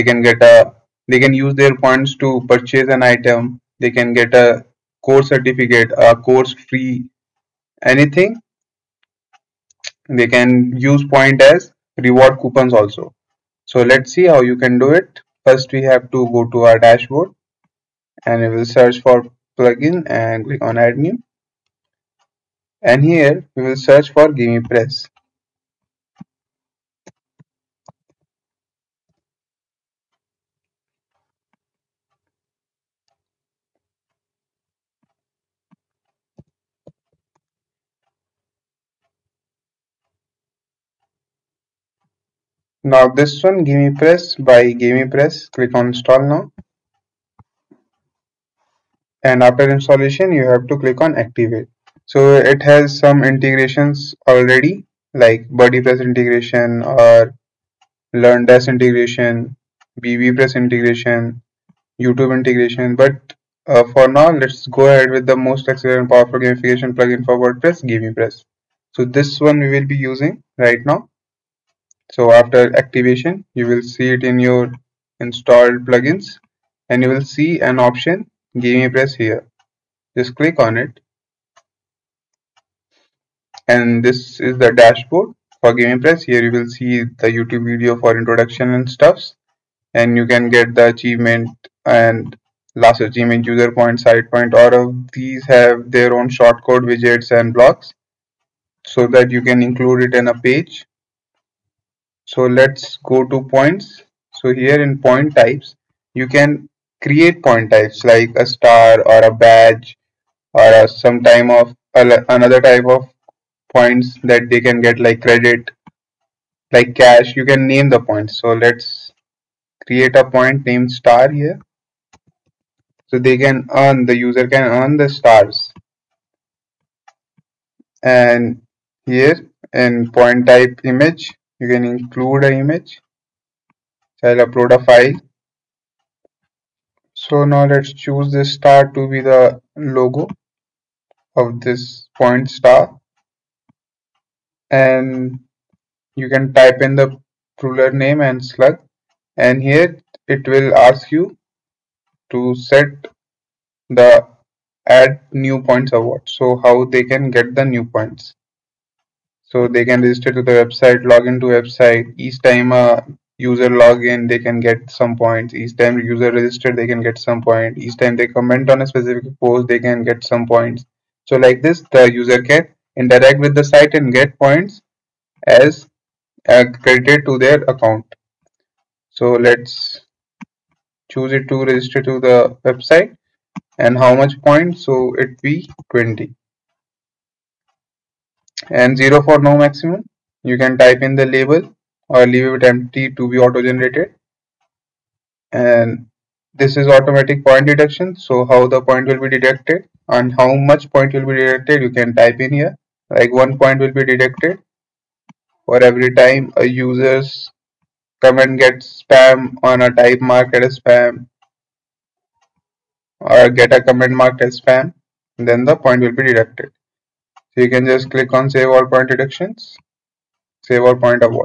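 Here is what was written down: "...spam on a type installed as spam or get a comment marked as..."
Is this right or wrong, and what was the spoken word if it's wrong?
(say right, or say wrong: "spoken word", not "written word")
wrong: "marked", not "installed".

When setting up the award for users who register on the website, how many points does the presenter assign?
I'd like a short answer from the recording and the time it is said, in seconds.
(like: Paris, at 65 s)
20, at 185 s.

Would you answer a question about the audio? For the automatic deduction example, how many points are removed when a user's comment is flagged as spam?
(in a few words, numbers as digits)
1.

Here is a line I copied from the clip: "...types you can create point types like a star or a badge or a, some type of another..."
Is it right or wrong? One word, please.
right.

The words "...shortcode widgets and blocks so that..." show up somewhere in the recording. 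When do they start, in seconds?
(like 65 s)
96 s.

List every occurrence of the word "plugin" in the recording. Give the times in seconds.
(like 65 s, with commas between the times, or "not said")
19 s, 66 s, 75 s.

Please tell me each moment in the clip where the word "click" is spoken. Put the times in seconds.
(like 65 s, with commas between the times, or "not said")
20 s, 45 s, 50 s, 80 s, 218 s.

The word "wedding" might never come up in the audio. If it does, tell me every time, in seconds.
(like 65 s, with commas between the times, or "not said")
not said.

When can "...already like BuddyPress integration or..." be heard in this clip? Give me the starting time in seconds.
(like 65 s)
54 s.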